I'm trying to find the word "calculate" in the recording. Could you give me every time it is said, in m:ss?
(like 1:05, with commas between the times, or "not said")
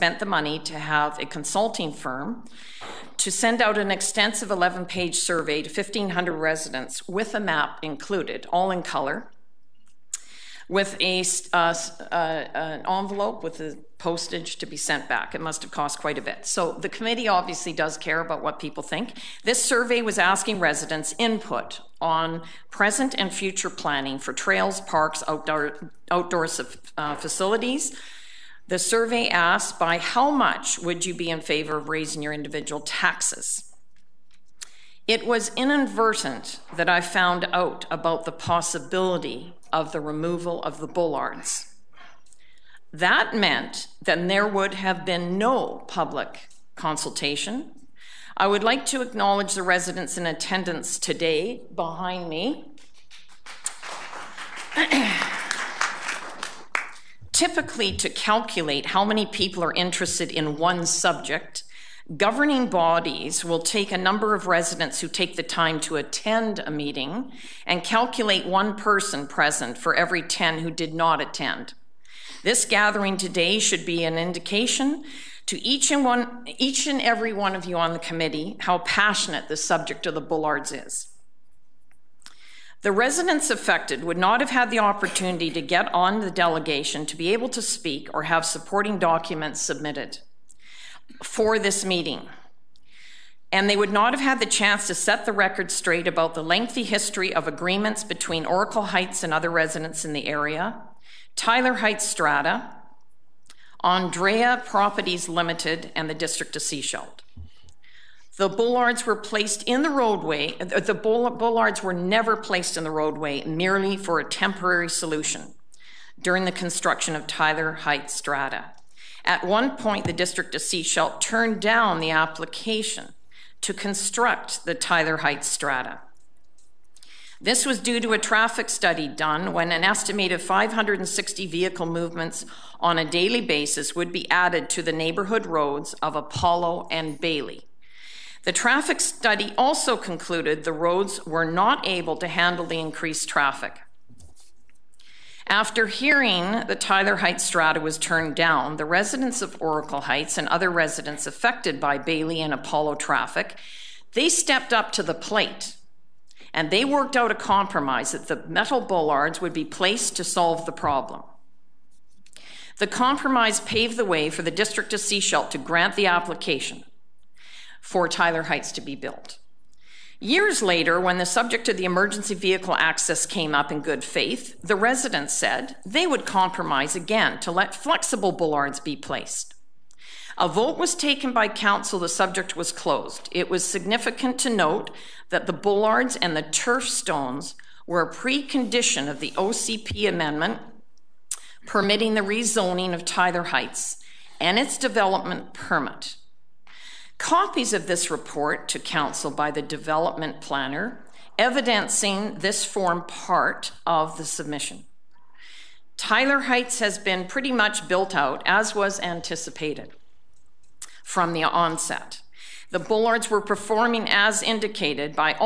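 0:58, 1:07.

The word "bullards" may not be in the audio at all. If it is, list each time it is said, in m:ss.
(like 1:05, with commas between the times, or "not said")
0:40, 1:20, 3:05.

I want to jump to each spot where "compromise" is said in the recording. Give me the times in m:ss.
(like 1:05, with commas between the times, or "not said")
2:37, 2:42, 2:56.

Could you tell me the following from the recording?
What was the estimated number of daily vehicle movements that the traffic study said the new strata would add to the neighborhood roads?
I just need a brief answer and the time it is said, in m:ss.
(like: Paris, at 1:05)
560, at 2:10.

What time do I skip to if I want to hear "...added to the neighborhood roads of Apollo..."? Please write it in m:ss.
2:14.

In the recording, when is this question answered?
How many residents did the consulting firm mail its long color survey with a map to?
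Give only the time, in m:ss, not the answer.
0:05.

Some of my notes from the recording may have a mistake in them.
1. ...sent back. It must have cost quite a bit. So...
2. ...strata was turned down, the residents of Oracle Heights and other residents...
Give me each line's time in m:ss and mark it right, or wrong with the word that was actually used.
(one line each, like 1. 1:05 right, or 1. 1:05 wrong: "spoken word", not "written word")
1. 0:14 right
2. 2:27 right.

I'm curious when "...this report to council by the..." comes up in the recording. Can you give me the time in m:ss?
3:17.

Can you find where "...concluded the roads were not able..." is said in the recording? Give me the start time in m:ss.
2:19.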